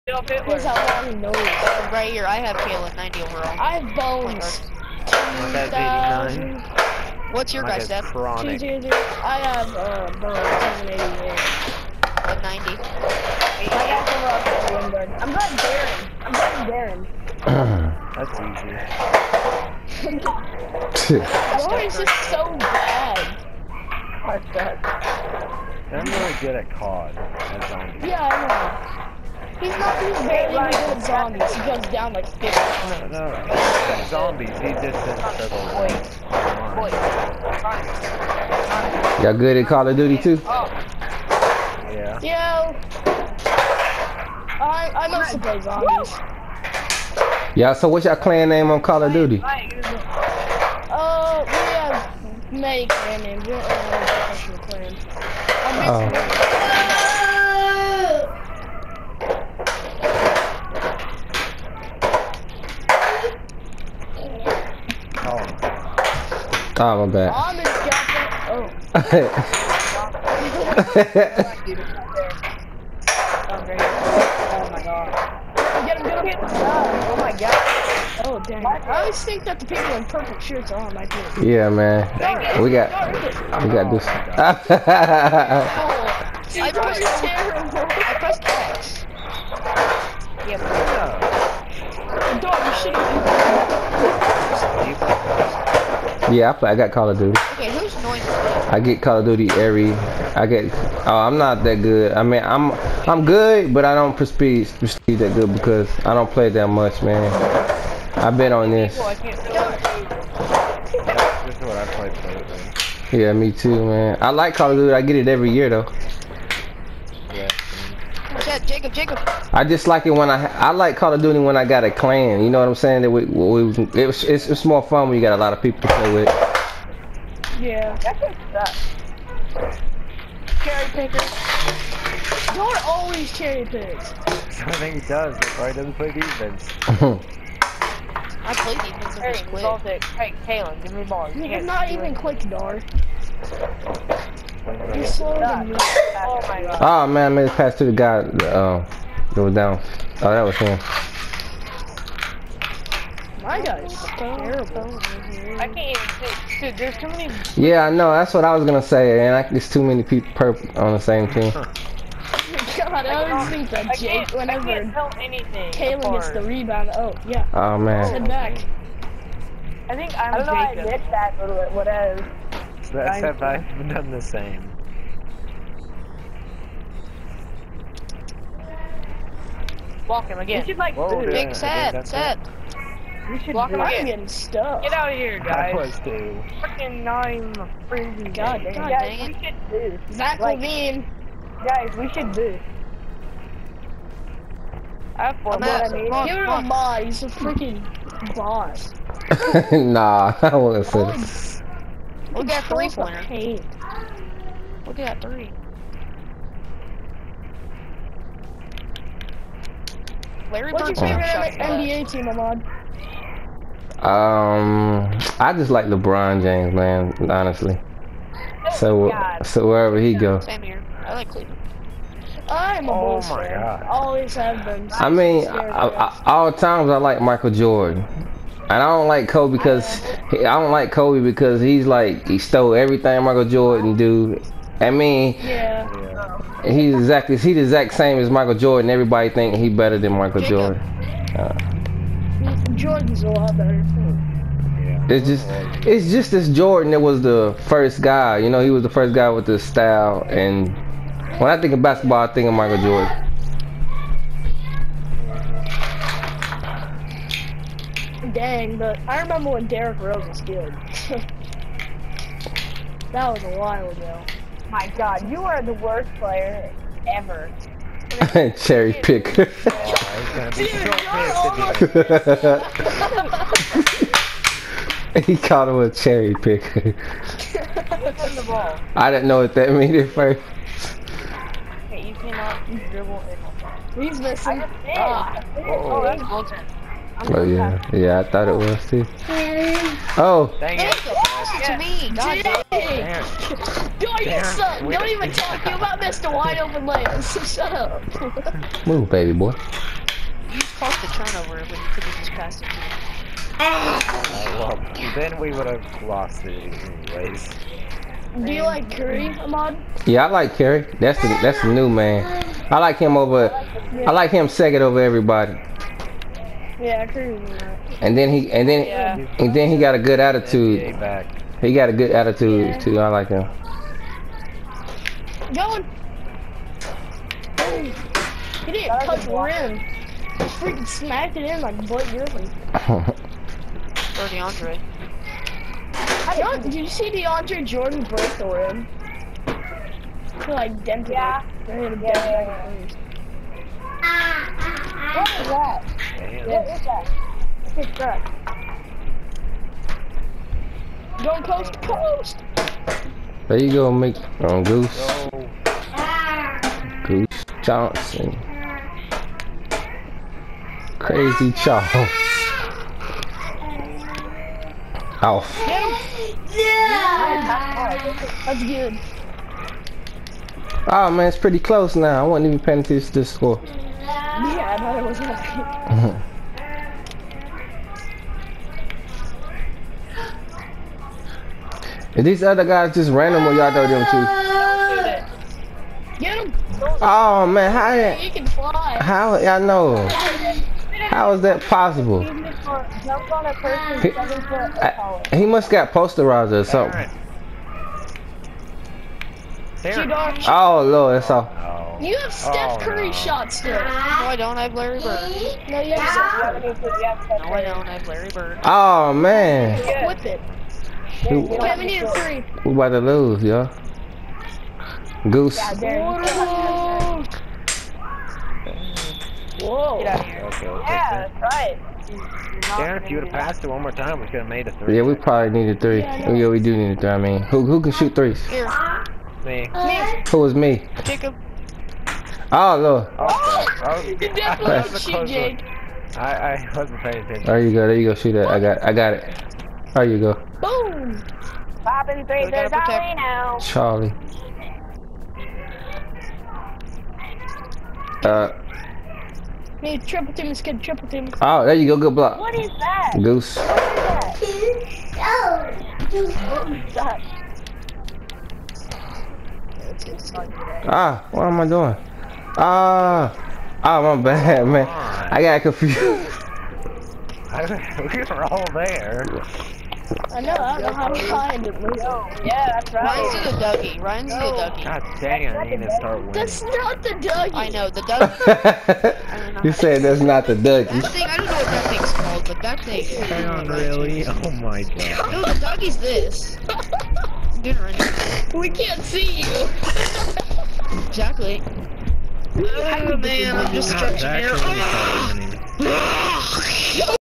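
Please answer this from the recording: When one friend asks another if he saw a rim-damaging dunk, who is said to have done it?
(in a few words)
DeAndre Jordan.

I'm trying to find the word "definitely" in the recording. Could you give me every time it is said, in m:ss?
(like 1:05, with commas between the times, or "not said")
7:14.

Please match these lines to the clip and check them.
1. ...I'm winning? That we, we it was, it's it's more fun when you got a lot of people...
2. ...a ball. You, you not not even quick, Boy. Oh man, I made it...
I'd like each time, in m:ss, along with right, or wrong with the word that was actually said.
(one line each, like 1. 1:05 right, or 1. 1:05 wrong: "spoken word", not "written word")
1. 2:02 wrong: "saying", not "winning"
2. 2:21 wrong: "Dar", not "Boy".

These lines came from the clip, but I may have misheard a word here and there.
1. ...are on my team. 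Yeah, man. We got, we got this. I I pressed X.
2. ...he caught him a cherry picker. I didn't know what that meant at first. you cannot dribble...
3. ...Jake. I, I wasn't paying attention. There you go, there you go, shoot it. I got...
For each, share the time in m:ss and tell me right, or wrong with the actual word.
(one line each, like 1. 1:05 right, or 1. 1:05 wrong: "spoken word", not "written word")
1. 1:20 right
2. 4:35 right
3. 7:15 right.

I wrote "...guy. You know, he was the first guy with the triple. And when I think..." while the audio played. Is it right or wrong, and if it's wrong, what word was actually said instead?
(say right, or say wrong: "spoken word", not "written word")
wrong: "style", not "triple".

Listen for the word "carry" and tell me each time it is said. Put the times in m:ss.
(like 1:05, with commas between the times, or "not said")
not said.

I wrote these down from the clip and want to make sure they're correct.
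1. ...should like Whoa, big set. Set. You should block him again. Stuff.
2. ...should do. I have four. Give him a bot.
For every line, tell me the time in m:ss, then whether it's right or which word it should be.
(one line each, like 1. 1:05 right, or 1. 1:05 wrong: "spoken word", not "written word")
1. 3:00 right
2. 3:12 right.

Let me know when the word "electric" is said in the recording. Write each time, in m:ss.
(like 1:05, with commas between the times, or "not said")
not said.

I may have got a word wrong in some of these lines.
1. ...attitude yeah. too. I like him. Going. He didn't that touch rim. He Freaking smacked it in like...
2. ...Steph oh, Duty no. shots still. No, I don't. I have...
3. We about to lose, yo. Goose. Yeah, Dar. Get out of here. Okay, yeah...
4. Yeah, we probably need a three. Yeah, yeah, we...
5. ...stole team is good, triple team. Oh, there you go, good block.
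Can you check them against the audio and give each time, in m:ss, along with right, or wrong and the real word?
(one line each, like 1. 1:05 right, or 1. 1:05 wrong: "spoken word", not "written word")
1. 5:22 right
2. 6:42 wrong: "Curry", not "Duty"
3. 6:52 wrong: "Whoa", not "Dar"
4. 7:04 right
5. 7:30 wrong: "triple", not "stole".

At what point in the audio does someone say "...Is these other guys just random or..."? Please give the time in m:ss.
6:22.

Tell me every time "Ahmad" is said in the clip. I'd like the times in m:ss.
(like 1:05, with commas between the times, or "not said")
3:32, 5:09.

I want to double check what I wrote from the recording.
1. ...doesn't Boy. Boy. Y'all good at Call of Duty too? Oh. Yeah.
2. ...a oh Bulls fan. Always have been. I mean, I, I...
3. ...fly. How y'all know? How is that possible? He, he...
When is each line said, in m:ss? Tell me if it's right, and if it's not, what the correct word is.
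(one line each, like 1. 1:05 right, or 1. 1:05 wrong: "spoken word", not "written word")
1. 0:35 right
2. 3:42 right
3. 6:28 right.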